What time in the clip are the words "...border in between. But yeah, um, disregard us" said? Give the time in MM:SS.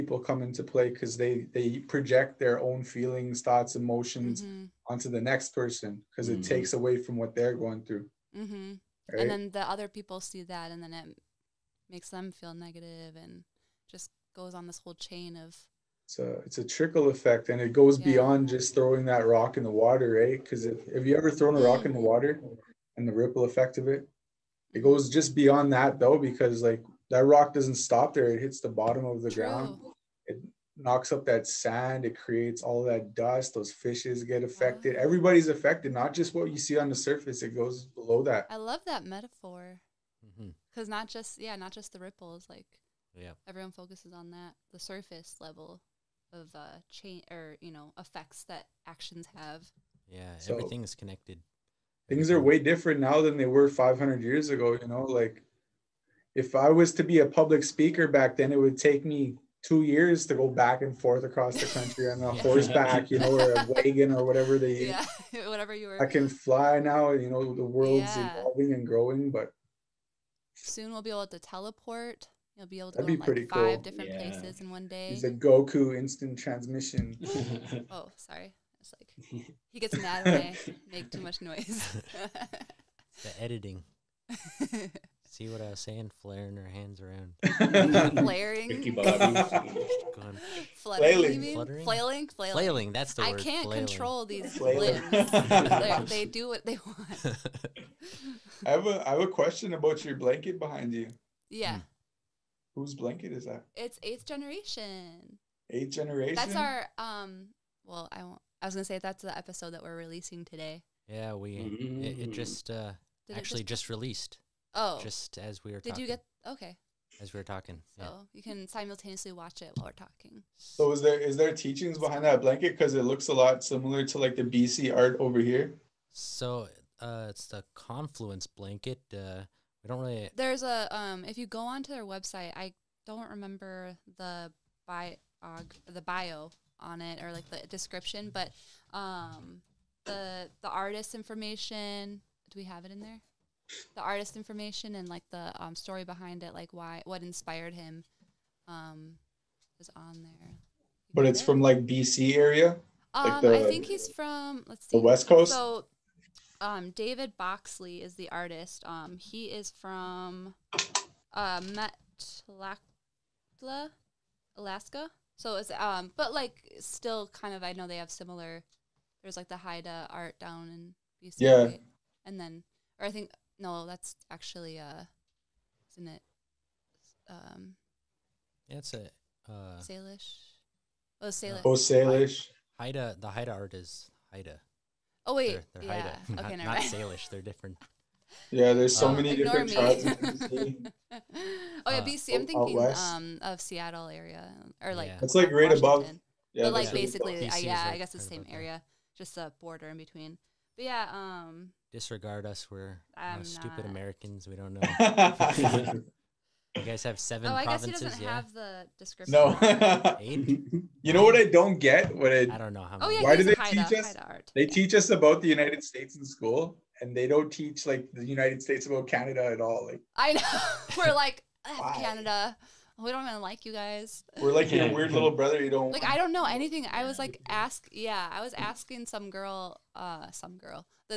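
03:19.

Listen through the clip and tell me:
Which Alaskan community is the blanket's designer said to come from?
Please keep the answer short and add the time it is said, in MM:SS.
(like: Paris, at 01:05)
Metlakatla, Alaska, at 02:41.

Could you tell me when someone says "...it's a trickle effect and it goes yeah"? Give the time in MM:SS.
00:16.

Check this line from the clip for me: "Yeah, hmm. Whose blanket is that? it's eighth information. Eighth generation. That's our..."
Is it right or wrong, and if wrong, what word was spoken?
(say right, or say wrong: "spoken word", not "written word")
wrong: "generation", not "information".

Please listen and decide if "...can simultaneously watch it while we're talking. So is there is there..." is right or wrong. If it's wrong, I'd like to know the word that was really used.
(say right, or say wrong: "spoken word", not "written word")
right.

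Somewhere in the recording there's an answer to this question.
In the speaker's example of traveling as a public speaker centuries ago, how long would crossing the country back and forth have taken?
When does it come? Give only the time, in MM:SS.
00:59.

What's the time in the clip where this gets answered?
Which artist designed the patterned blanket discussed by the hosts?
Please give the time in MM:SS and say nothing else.
02:36.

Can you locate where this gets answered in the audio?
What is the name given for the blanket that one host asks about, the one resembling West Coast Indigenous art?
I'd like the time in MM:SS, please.
02:07.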